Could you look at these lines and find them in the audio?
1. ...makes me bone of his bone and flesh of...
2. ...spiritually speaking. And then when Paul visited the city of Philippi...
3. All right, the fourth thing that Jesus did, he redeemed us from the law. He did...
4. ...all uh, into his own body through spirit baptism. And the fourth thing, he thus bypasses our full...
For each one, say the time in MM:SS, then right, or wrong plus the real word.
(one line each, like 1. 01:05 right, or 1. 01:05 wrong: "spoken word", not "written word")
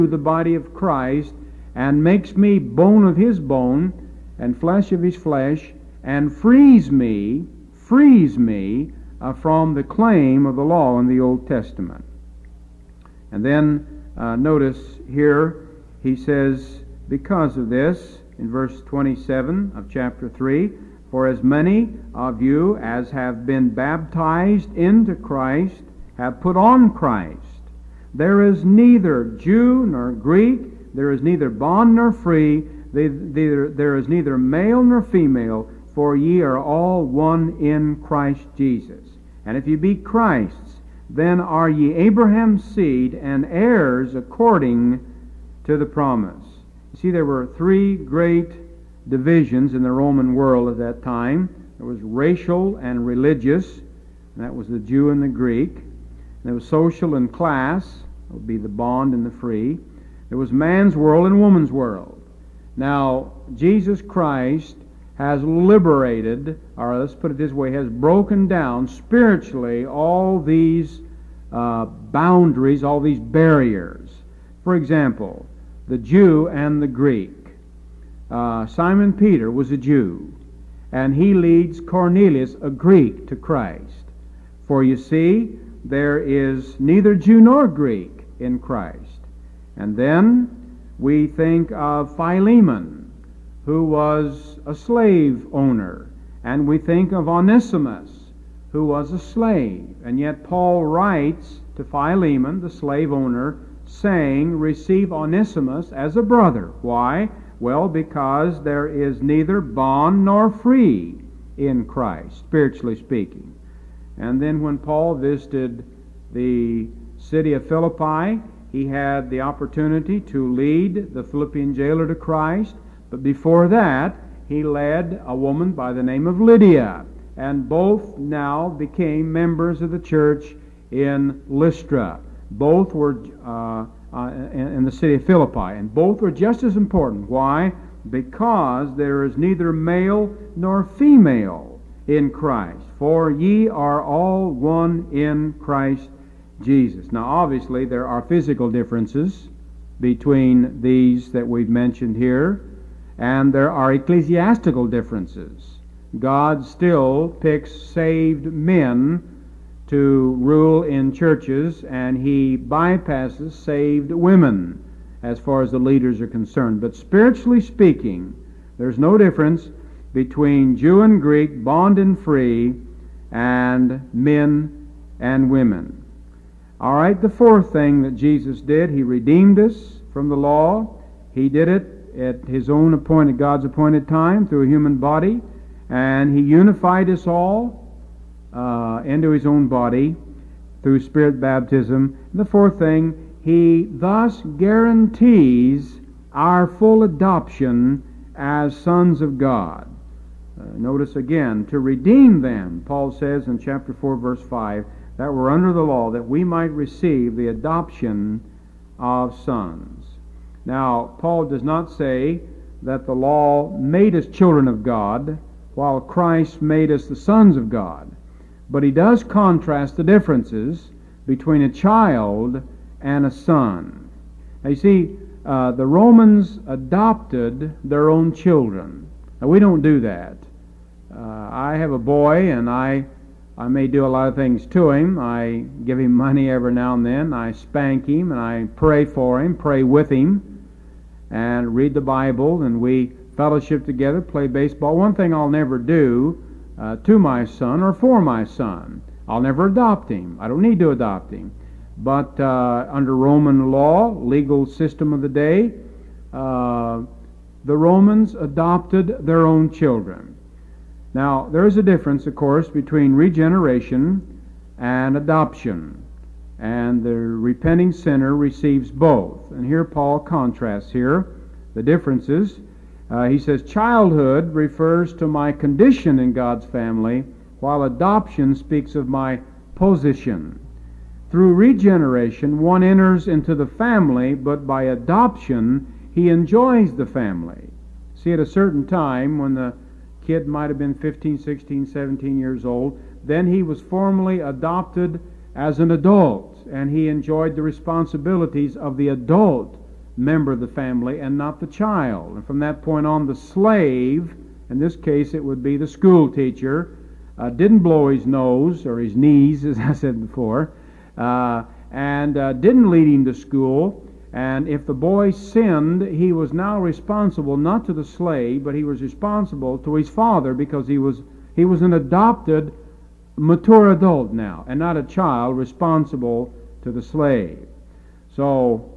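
1. 00:02 right
2. 01:52 right
3. 02:56 right
4. 03:07 wrong: "guarantees", not "bypasses".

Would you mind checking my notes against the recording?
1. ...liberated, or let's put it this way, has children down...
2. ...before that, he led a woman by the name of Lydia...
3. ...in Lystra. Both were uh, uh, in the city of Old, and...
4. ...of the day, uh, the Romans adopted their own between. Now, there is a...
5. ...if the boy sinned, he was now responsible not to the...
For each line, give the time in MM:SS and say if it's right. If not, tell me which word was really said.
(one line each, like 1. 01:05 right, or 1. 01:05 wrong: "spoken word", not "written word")
1. 01:05 wrong: "broken", not "children"
2. 02:03 right
3. 02:10 wrong: "Philippi", not "Old"
4. 04:15 wrong: "children", not "between"
5. 05:14 right.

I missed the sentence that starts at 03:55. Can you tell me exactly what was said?
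I give him money every now and then.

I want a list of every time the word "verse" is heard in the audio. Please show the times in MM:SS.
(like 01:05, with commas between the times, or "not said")
00:18, 03:24.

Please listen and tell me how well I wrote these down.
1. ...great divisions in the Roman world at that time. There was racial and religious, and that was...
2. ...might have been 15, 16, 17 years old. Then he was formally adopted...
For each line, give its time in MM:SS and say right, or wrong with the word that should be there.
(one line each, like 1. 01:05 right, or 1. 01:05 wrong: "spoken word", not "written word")
1. 00:47 right
2. 04:50 right.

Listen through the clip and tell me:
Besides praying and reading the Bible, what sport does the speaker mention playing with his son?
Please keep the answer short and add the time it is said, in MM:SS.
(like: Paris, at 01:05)
baseball, at 04:04.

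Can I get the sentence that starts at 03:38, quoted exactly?
But he does contrast the differences between a child and a son.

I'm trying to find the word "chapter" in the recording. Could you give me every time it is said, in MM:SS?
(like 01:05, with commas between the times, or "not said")
00:19, 03:23.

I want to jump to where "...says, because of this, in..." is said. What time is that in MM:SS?
00:16.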